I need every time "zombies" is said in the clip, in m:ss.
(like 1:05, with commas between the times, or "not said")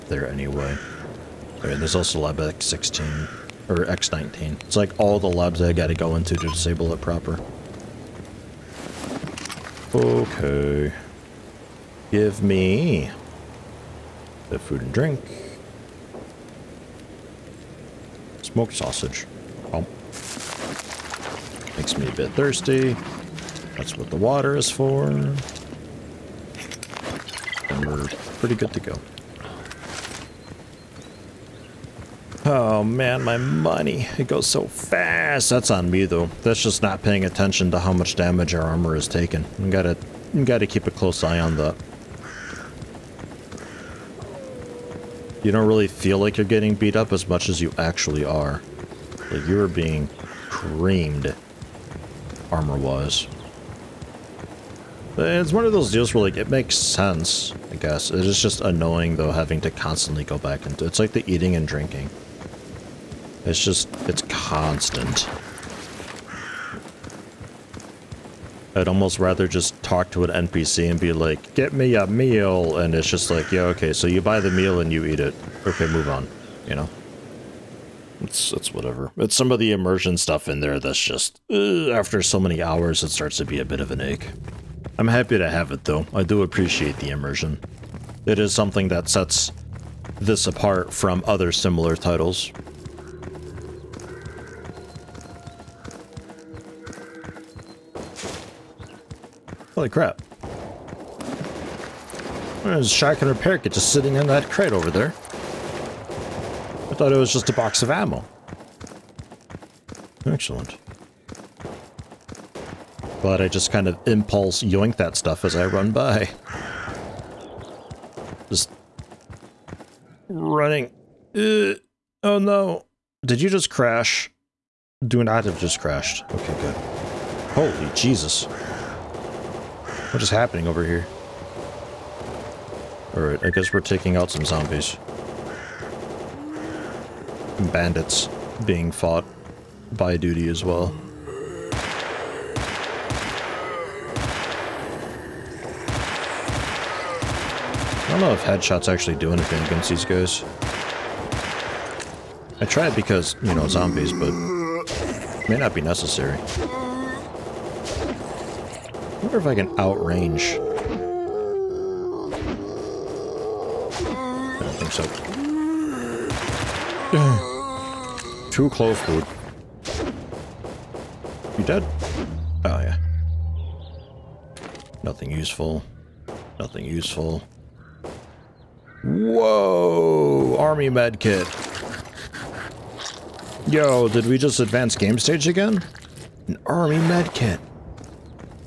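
2:14, 2:33.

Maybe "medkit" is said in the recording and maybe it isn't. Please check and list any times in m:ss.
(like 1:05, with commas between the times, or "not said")
3:00, 3:06.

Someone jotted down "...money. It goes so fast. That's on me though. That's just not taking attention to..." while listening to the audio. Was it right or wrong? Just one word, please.
wrong.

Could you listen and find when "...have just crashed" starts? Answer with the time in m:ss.
2:05.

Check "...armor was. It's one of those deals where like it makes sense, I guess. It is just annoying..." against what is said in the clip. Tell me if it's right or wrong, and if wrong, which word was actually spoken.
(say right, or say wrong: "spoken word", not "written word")
right.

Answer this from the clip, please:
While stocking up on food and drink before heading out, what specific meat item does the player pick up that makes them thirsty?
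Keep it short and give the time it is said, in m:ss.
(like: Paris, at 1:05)
Smoked sausage, at 0:18.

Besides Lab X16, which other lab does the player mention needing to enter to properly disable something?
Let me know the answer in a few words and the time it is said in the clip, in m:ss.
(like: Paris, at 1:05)
X19, at 0:03.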